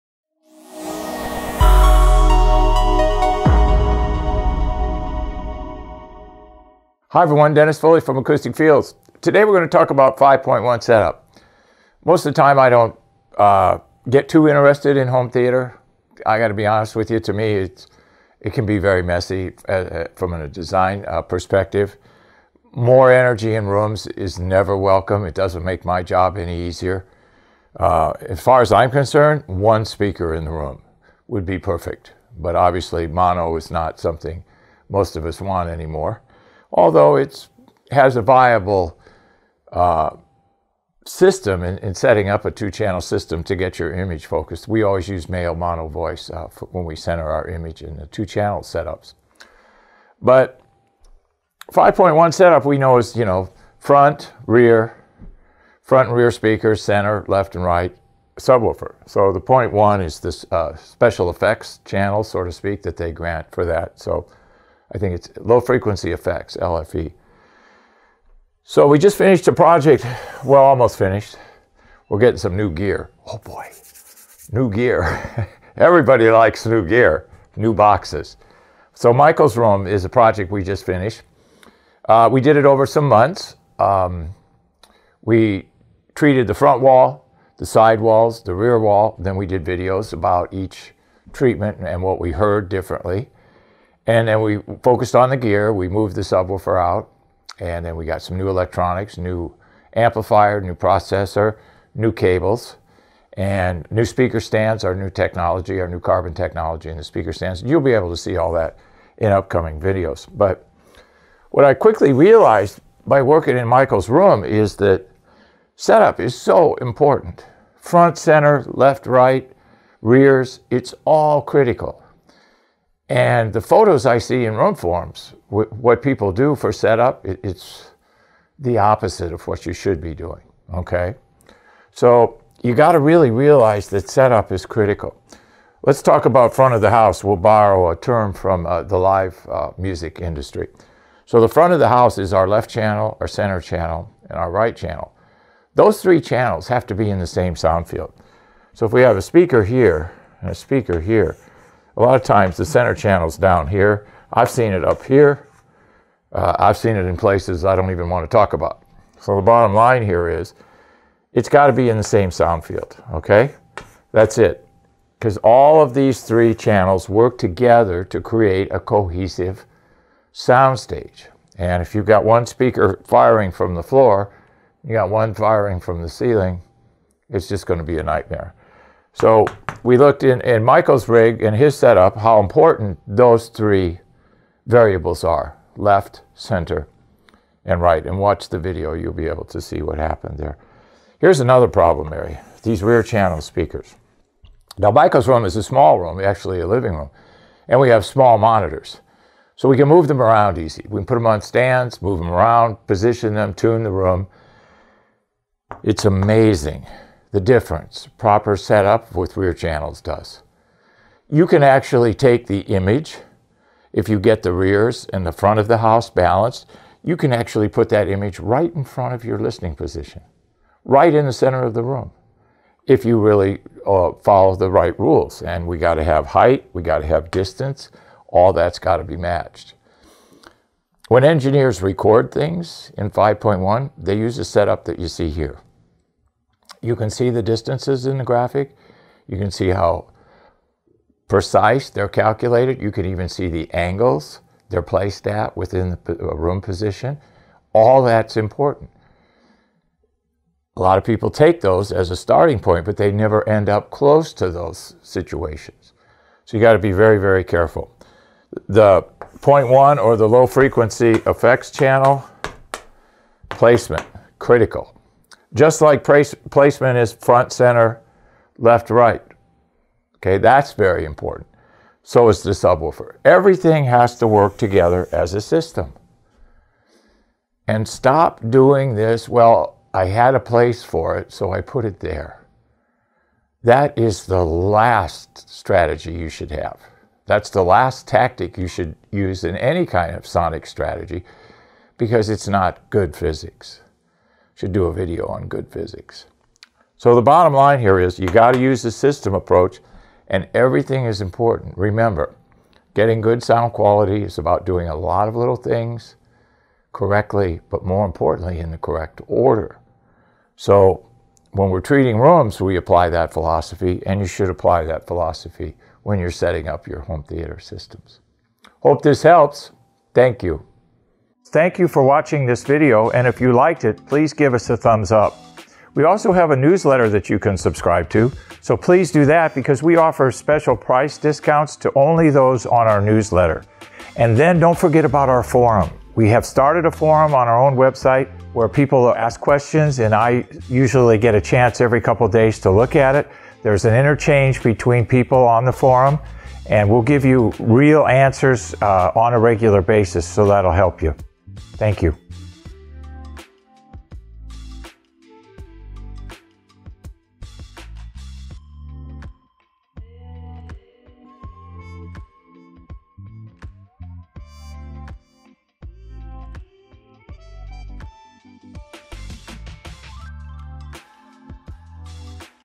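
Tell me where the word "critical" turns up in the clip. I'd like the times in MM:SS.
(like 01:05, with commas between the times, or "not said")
02:01, 02:14, 04:24.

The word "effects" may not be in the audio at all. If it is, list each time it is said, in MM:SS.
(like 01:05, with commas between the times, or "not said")
01:01, 01:06, 04:21.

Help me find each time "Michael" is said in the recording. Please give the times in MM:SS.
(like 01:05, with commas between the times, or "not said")
01:19, 01:53, 03:00, 03:14.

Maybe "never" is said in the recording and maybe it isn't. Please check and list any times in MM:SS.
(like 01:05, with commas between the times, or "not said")
00:24, 04:13.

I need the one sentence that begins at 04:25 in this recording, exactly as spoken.
Just like place, placement is front, center, left, right.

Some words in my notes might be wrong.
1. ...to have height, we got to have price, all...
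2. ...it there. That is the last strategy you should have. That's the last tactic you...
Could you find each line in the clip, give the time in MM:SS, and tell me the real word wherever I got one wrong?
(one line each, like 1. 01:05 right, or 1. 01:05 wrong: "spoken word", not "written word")
1. 03:45 wrong: "distance", not "price"
2. 04:41 right.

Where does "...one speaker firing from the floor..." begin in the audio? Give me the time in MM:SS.
02:52.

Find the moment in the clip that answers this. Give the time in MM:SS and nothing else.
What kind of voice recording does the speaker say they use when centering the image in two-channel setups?
00:45.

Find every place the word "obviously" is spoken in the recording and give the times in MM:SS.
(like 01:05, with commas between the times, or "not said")
00:32.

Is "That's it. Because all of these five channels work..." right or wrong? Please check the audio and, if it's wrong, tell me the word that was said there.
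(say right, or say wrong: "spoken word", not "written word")
wrong: "three", not "five".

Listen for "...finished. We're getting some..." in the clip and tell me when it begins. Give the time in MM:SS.
01:10.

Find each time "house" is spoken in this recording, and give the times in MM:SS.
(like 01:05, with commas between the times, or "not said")
02:16, 02:21, 03:35.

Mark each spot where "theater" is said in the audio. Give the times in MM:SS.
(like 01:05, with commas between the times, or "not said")
00:15, 05:17.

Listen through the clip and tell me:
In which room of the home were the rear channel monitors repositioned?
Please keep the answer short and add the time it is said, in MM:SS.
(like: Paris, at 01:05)
Living room, at 03:16.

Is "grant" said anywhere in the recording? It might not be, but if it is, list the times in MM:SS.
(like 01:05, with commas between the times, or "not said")
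01:03.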